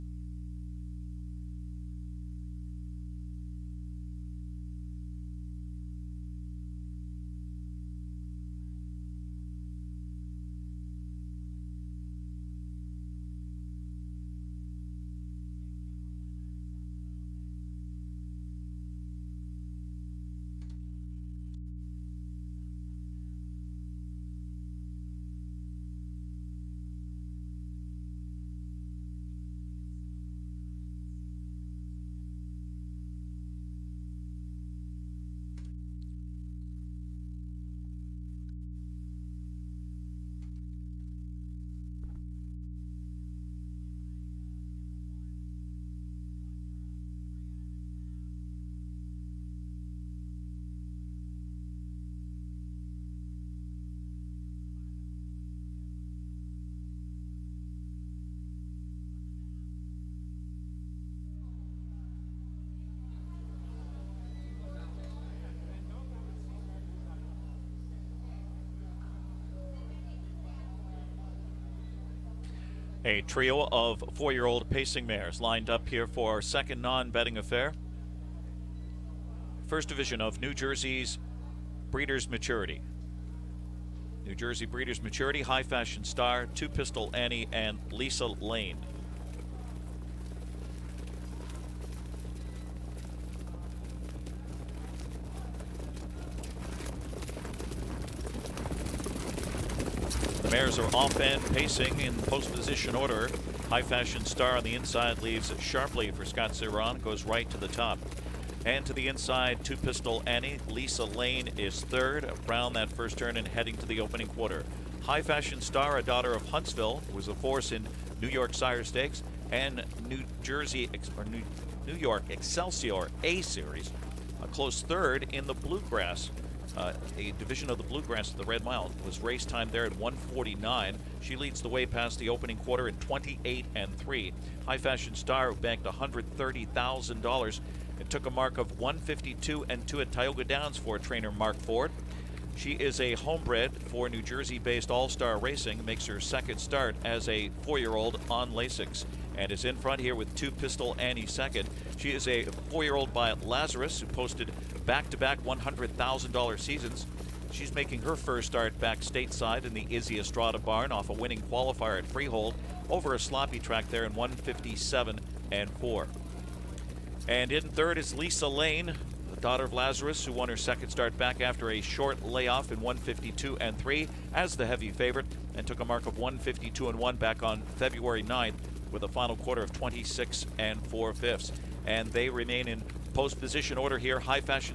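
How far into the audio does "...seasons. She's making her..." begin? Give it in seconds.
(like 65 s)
156 s.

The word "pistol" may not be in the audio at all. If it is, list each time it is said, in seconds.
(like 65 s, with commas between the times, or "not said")
86 s, 109 s, 150 s.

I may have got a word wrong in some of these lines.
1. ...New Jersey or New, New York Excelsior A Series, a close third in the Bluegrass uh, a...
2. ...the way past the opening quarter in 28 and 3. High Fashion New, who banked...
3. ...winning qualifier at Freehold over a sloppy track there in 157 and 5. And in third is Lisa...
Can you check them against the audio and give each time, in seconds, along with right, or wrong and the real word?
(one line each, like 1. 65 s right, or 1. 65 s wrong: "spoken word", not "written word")
1. 120 s right
2. 131 s wrong: "Star", not "New"
3. 161 s wrong: "4", not "5".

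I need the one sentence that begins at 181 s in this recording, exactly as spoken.
And they remain in post position order here.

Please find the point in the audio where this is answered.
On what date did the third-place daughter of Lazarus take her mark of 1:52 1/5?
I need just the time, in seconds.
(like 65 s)
177 s.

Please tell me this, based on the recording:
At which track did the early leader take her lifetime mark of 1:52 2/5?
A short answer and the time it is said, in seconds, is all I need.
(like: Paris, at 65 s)
Tioga Downs, at 140 s.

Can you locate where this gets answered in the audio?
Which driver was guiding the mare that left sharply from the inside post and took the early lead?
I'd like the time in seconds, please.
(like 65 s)
106 s.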